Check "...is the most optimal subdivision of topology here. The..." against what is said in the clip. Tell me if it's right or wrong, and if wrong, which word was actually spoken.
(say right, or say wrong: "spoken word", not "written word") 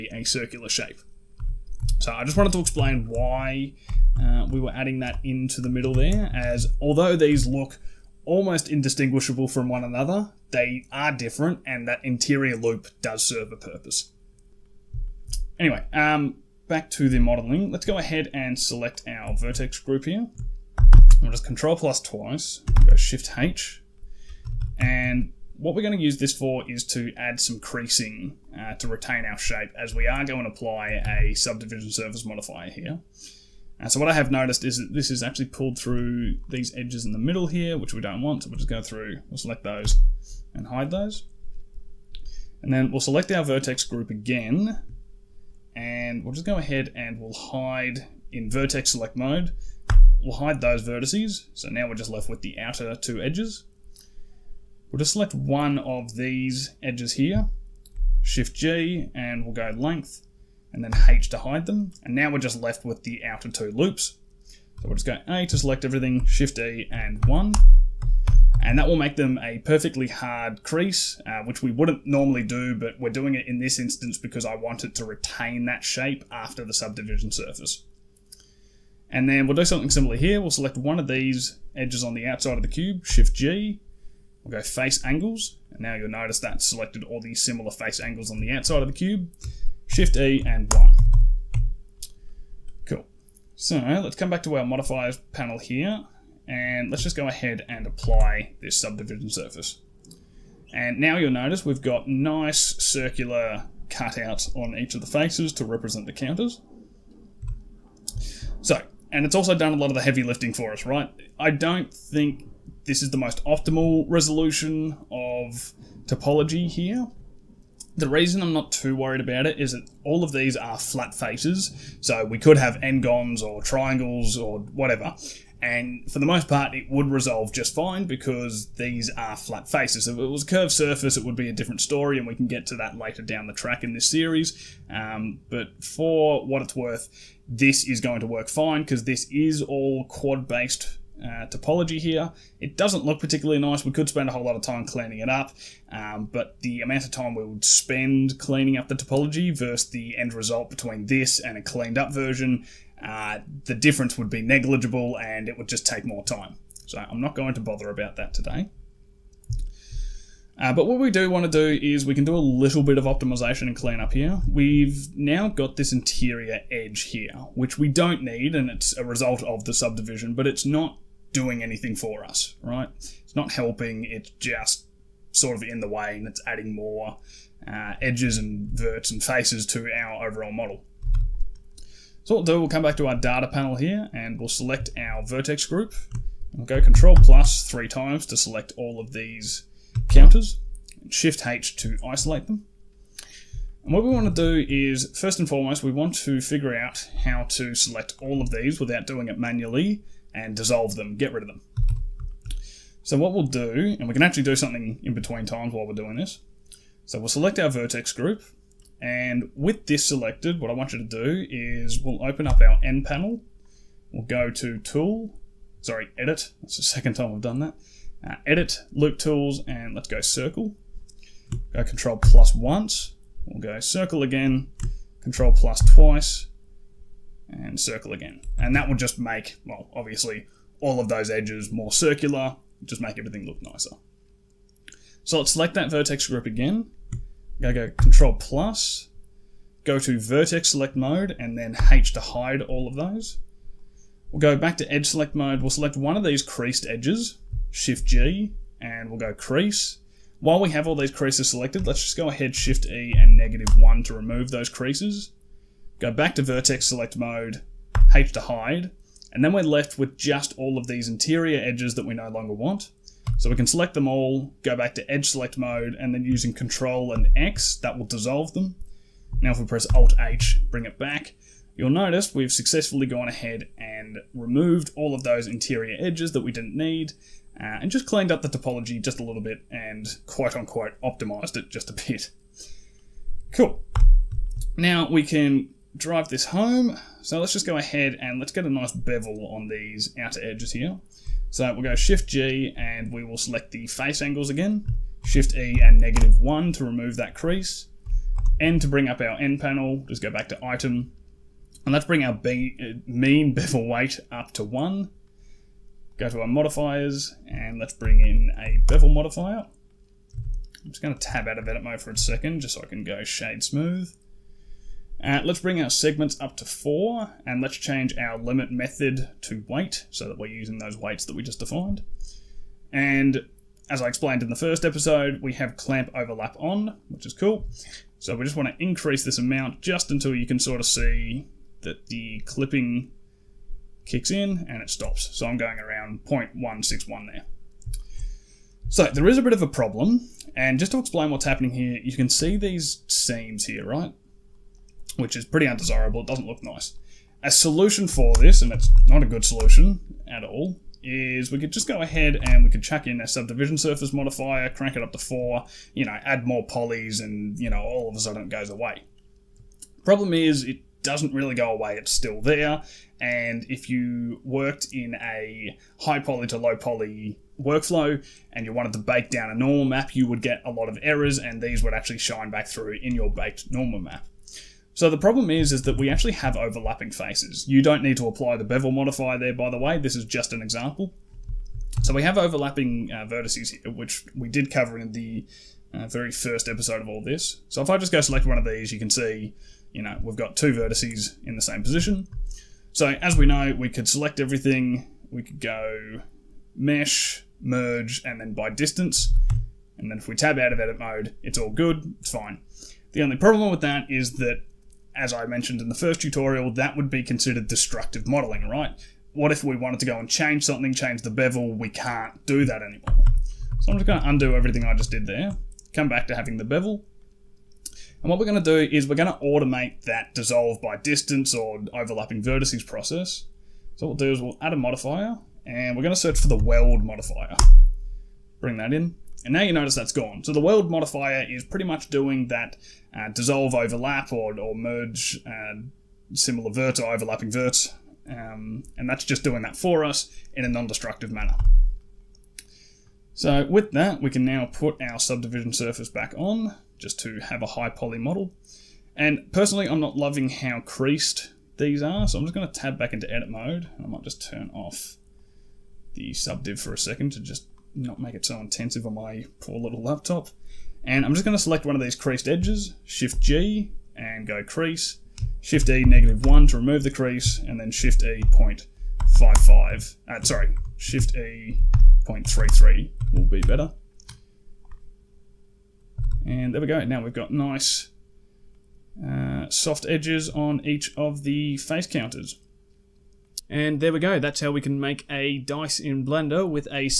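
wrong: "resolution", not "subdivision".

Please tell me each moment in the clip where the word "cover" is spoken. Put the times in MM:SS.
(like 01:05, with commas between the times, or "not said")
06:24.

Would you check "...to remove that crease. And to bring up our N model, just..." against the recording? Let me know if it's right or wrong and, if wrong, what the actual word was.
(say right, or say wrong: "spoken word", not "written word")
wrong: "panel", not "model".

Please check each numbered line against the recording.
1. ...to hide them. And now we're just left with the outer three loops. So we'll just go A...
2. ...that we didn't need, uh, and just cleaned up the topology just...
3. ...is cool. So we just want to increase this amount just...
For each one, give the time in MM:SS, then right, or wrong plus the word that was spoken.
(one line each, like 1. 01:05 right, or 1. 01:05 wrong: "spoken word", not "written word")
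1. 01:01 wrong: "two", not "three"
2. 04:36 right
3. 05:27 right.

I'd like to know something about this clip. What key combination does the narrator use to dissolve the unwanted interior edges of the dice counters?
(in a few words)
Control and X.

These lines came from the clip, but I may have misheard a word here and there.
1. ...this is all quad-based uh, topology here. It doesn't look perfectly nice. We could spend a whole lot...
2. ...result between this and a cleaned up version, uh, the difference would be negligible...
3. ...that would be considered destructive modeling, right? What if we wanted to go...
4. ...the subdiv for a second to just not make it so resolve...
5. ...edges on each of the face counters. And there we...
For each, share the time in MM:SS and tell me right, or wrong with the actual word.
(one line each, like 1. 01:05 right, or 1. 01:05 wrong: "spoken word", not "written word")
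1. 02:19 wrong: "particularly", not "perfectly"
2. 02:30 right
3. 06:46 right
4. 07:36 wrong: "intensive", not "resolve"
5. 08:00 right.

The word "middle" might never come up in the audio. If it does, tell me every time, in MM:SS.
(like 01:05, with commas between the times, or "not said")
00:05, 00:37.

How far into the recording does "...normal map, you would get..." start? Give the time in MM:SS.
06:09.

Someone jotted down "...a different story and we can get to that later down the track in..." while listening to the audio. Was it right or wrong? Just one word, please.
right.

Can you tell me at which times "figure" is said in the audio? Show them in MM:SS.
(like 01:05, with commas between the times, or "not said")
03:16.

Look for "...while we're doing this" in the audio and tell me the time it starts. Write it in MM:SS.
03:25.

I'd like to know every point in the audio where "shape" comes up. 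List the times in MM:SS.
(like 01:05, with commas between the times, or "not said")
00:00, 00:29, 01:15.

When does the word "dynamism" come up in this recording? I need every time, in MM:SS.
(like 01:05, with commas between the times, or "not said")
not said.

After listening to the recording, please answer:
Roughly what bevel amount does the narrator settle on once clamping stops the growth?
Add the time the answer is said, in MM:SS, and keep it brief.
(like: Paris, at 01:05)
0.161, at 05:36.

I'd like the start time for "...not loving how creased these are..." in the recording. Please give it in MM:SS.
07:30.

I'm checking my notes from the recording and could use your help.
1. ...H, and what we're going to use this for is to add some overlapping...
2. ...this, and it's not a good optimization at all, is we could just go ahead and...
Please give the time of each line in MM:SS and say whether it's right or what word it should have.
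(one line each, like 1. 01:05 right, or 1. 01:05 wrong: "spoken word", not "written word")
1. 00:23 wrong: "creasing", not "overlapping"
2. 05:48 wrong: "solution", not "optimization".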